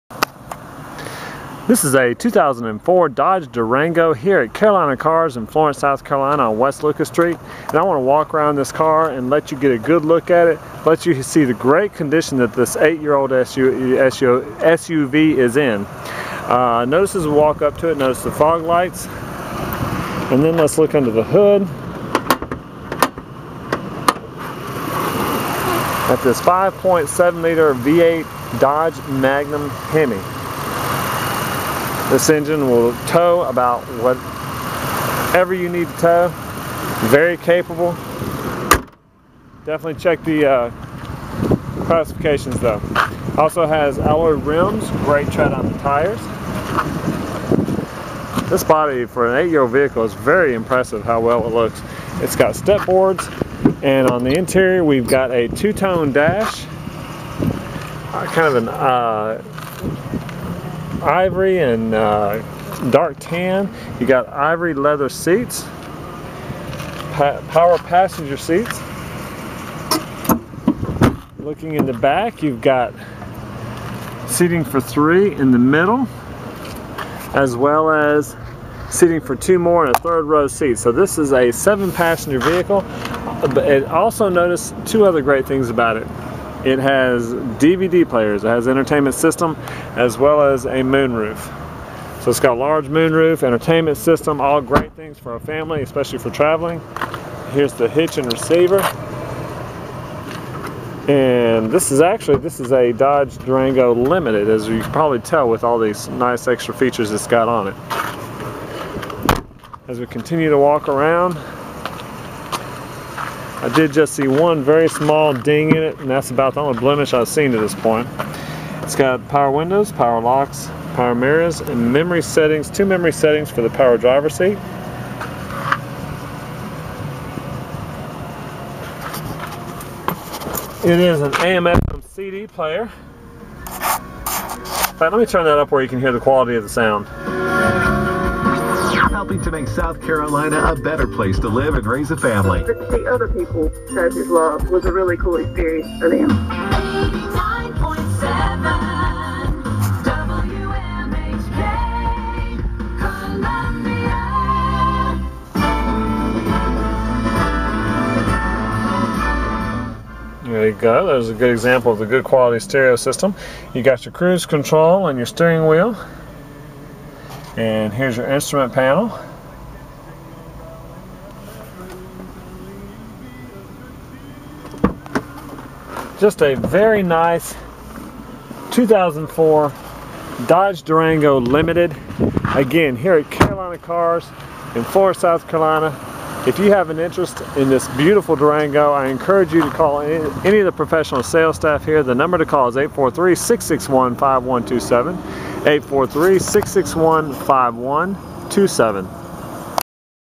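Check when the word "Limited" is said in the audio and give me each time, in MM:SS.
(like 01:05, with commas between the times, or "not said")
01:43, 03:01.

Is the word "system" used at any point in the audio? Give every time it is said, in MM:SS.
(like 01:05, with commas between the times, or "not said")
01:29, 01:33, 02:42.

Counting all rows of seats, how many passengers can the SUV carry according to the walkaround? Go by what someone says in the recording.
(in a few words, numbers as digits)
7.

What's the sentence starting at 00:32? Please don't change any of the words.
This engine will tow about whatever you need to tow.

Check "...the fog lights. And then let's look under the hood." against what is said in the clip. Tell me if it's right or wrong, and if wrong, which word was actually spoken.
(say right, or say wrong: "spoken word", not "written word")
right.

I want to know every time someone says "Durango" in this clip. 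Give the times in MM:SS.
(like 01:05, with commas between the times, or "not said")
00:03, 01:43, 03:00, 03:08.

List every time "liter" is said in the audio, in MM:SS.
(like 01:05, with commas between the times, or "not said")
00:27.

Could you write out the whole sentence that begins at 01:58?
It's got power windows, power locks, power mirrors, and memory settings, two memory settings for the power driver seat.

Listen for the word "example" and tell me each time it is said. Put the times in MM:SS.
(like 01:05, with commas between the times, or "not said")
02:41.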